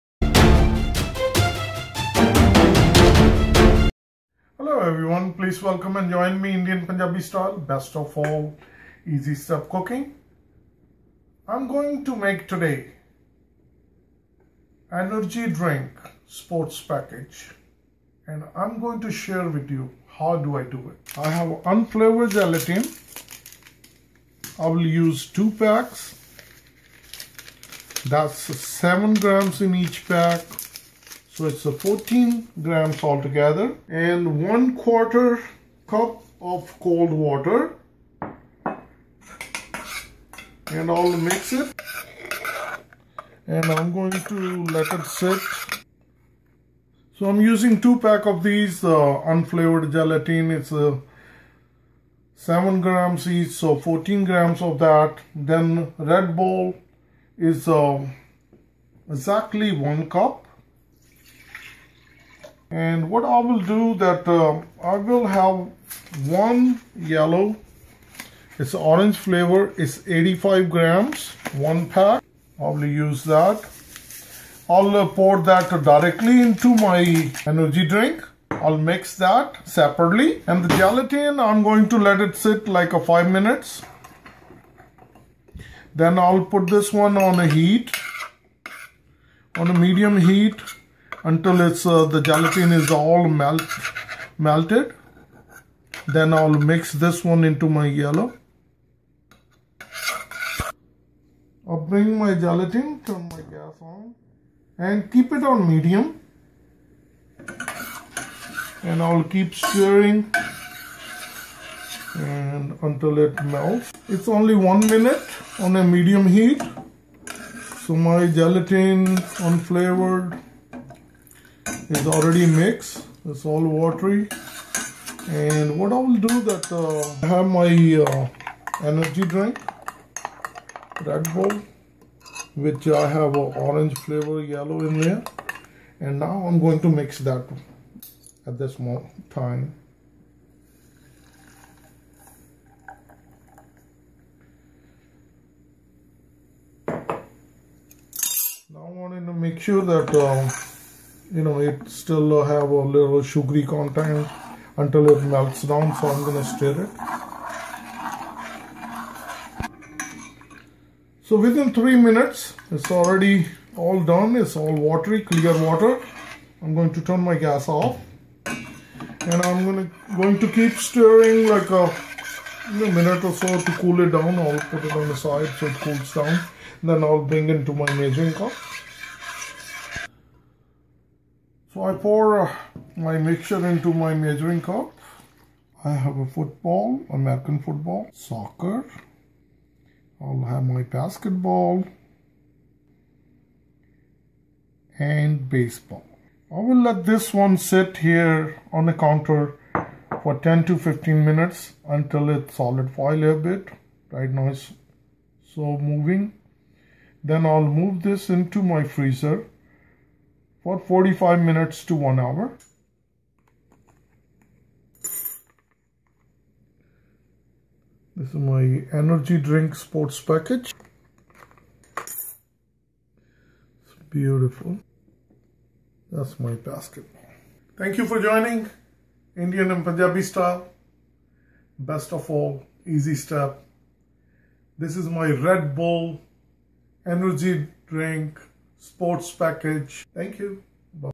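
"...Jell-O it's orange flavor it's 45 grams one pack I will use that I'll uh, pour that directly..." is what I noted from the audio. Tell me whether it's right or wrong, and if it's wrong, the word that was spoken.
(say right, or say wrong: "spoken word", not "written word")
wrong: "85", not "45".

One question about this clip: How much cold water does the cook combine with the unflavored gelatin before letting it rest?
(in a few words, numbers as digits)
1/4 cup.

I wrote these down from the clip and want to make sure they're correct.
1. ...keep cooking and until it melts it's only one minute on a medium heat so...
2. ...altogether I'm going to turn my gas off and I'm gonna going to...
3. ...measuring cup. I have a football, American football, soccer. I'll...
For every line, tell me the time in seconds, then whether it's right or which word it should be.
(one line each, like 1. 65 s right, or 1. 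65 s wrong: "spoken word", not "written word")
1. 109 s wrong: "stirring", not "cooking"
2. 165 s wrong: "water", not "altogether"
3. 184 s right.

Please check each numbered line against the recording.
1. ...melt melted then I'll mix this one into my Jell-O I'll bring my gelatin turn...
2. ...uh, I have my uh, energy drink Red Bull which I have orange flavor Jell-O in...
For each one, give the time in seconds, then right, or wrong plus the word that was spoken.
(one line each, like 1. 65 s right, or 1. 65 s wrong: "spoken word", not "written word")
1. 93 s right
2. 126 s right.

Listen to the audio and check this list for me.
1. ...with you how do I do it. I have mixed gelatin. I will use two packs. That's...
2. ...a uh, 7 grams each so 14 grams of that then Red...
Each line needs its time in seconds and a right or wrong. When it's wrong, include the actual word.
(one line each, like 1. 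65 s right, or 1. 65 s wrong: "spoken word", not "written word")
1. 19 s wrong: "unflavored", not "mixed"
2. 50 s right.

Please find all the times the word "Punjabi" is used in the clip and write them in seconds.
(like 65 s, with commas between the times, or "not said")
6 s, 229 s.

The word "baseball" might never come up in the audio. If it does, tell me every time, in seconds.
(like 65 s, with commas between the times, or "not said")
195 s.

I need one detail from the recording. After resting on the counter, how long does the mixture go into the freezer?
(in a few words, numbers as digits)
45 minutes to 1 hour.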